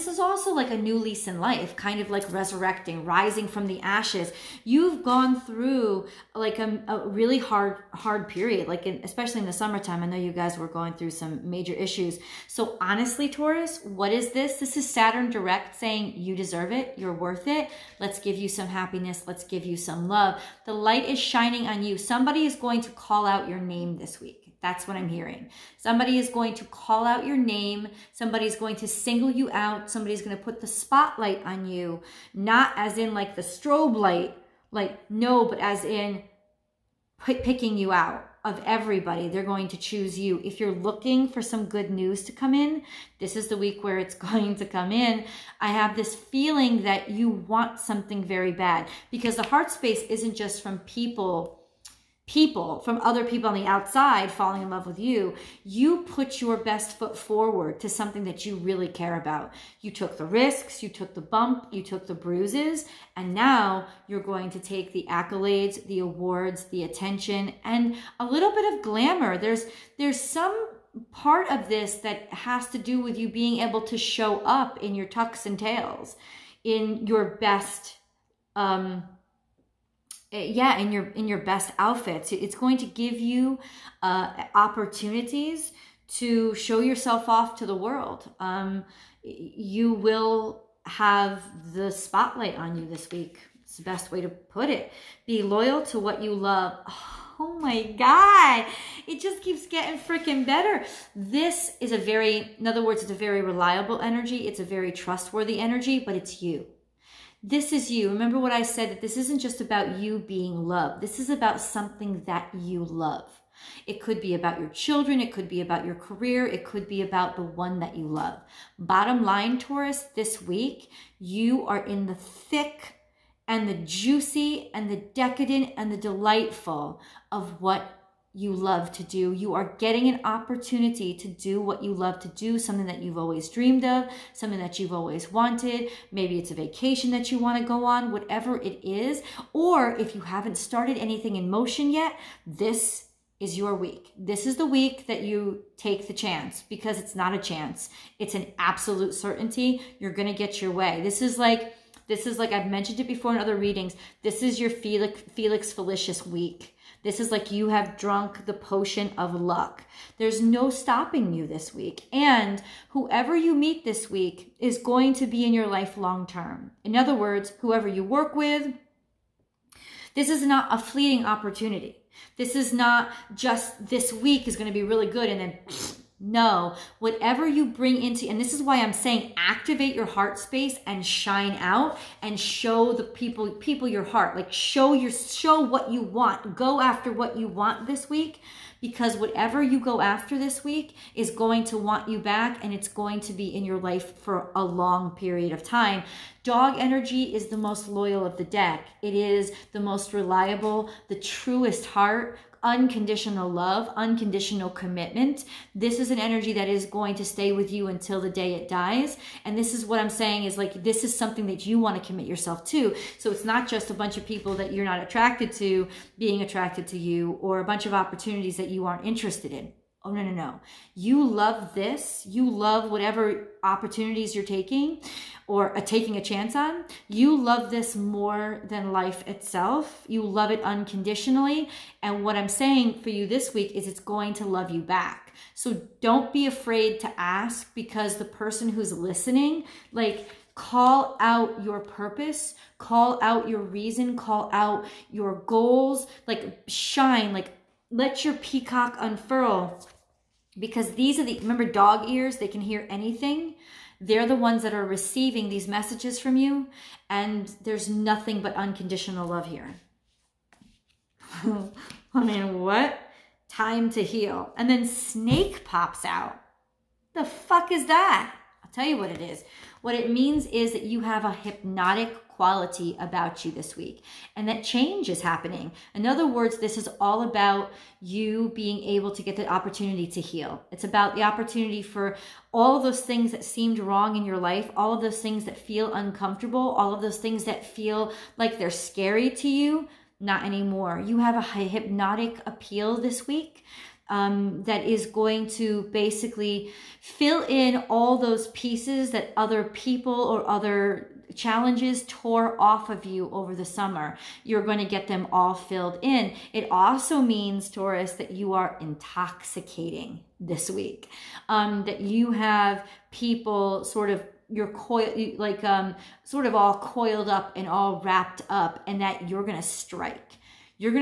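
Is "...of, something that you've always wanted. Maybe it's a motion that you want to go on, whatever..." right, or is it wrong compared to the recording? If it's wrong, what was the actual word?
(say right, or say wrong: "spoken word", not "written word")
wrong: "vacation", not "motion".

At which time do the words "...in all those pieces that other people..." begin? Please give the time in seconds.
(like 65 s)
297 s.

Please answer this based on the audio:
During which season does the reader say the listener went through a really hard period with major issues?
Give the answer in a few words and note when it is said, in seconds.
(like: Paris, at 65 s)
Summertime, at 9 s.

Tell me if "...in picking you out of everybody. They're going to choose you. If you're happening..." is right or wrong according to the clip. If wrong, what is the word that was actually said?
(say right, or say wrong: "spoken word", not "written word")
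wrong: "looking", not "happening".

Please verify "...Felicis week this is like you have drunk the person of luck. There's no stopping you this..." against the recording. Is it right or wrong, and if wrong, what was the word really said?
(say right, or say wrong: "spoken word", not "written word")
wrong: "potion", not "person".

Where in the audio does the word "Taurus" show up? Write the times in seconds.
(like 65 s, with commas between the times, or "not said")
13 s, 119 s, 307 s.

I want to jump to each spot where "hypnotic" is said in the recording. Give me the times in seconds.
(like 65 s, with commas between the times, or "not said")
271 s, 291 s.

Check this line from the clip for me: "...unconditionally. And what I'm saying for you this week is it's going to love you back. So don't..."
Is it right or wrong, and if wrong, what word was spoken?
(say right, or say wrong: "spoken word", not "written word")
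right.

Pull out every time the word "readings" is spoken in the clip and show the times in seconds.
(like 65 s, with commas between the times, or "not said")
153 s.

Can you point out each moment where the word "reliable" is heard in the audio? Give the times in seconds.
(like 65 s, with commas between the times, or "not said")
103 s, 200 s.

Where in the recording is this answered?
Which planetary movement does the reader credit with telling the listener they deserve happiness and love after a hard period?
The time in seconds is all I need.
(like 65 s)
14 s.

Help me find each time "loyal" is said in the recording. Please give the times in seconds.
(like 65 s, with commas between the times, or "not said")
95 s, 197 s.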